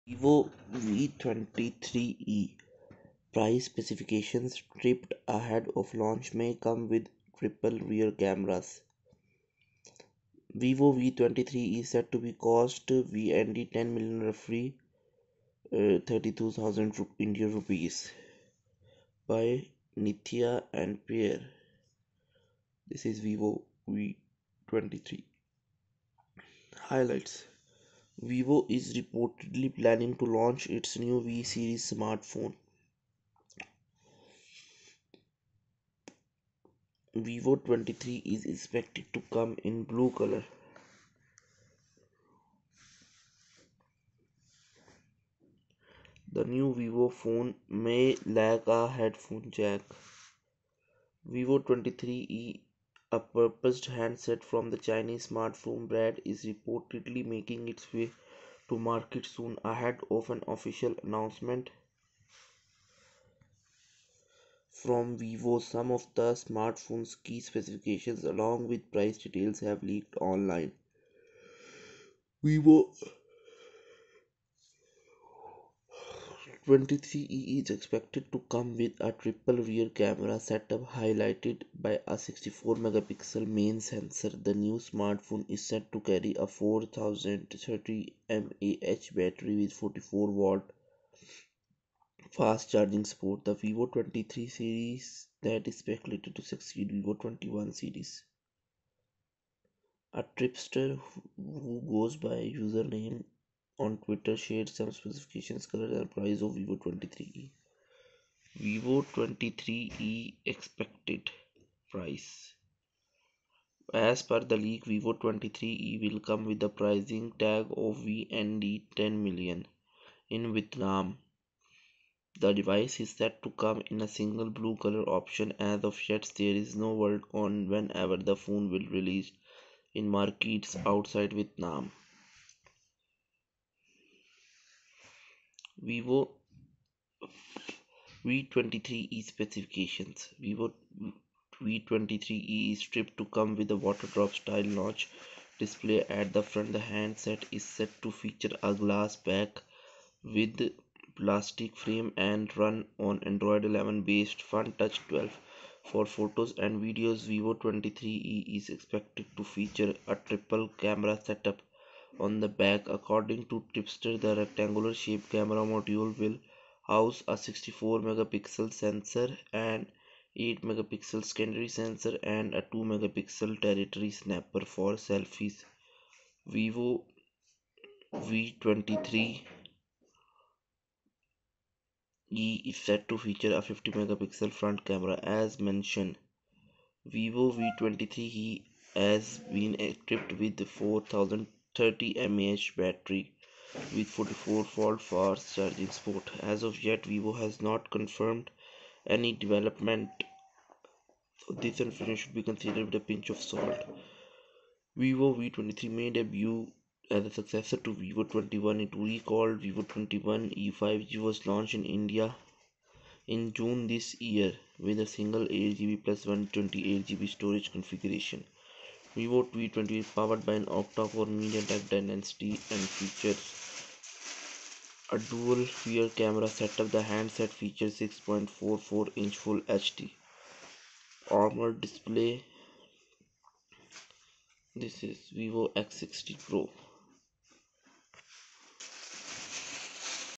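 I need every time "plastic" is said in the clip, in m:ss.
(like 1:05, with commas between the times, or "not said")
2:31.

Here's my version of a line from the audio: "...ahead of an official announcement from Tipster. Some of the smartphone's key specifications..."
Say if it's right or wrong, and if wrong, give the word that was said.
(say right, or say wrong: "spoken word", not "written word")
wrong: "Vivo", not "Tipster".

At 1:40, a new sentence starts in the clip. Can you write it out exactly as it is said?
A tripster who goes by username on Twitter shared some specifications, colors, and price of Vivo 23e.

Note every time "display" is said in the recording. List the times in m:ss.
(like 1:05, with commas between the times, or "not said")
2:25, 3:51.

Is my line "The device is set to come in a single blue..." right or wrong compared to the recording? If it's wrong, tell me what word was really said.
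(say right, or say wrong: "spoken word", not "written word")
right.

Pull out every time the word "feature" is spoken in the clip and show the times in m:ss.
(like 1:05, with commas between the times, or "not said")
2:28, 2:39, 3:03, 3:42, 3:47.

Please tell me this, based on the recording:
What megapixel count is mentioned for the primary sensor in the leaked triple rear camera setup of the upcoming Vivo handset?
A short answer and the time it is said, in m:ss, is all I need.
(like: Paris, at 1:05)
64 megapixel, at 1:22.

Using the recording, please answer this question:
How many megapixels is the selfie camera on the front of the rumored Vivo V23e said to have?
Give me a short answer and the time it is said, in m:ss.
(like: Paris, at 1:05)
50 megapixel, at 3:03.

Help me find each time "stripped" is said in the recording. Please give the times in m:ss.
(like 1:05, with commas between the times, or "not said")
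2:22.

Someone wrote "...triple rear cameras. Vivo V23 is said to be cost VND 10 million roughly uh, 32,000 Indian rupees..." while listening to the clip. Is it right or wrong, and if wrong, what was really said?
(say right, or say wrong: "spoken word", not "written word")
right.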